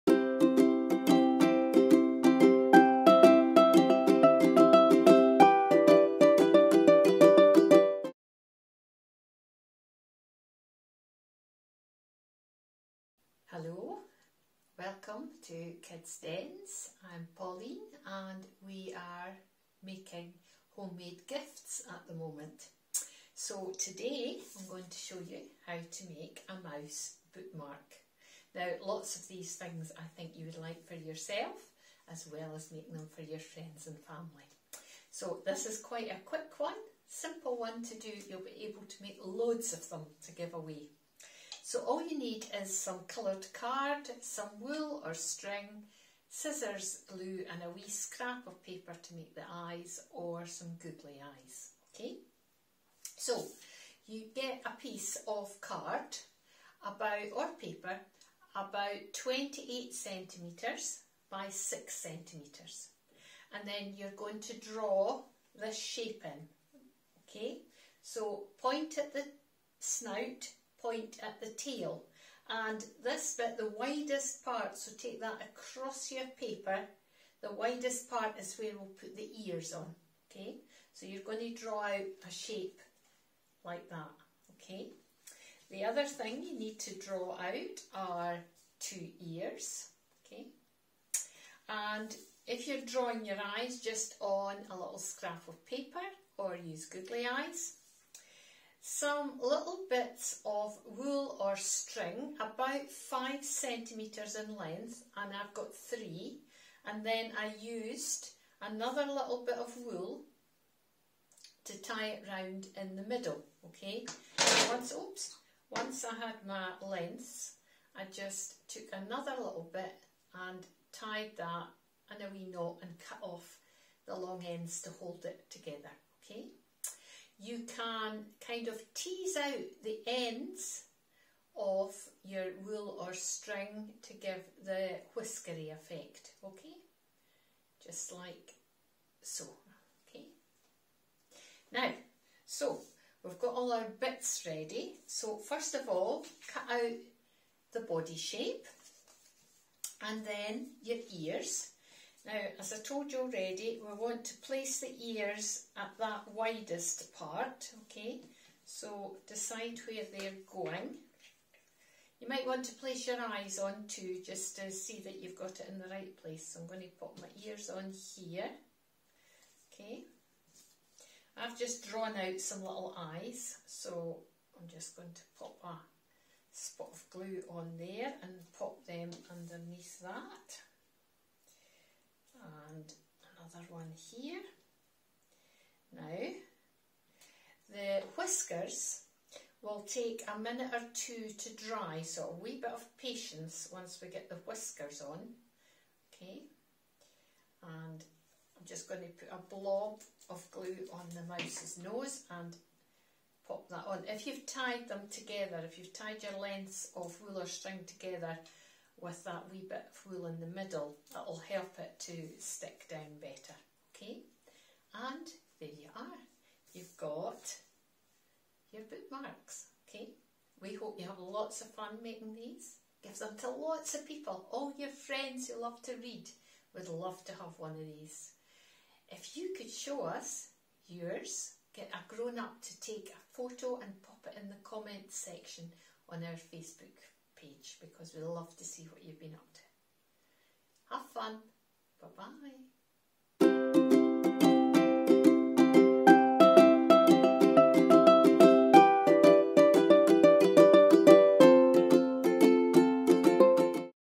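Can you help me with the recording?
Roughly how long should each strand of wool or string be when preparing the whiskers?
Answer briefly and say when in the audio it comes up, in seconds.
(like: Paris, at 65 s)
5 centimetres, at 102 s.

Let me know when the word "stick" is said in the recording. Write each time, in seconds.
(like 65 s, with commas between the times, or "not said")
212 s.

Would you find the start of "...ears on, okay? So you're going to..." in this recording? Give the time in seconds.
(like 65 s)
79 s.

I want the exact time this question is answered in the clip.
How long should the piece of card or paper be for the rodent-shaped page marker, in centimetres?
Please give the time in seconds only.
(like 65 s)
59 s.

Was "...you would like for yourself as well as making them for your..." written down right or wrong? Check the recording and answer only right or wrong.
right.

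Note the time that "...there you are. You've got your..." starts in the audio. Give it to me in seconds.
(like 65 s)
215 s.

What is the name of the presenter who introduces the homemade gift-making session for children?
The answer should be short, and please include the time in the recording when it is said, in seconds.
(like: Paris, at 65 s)
Pauline, at 17 s.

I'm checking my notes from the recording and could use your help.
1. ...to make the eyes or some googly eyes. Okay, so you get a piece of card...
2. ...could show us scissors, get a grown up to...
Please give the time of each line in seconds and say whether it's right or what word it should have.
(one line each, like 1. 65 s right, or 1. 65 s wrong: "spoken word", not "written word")
1. 49 s right
2. 229 s wrong: "yours", not "scissors".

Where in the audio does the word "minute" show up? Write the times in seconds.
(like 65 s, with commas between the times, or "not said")
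190 s.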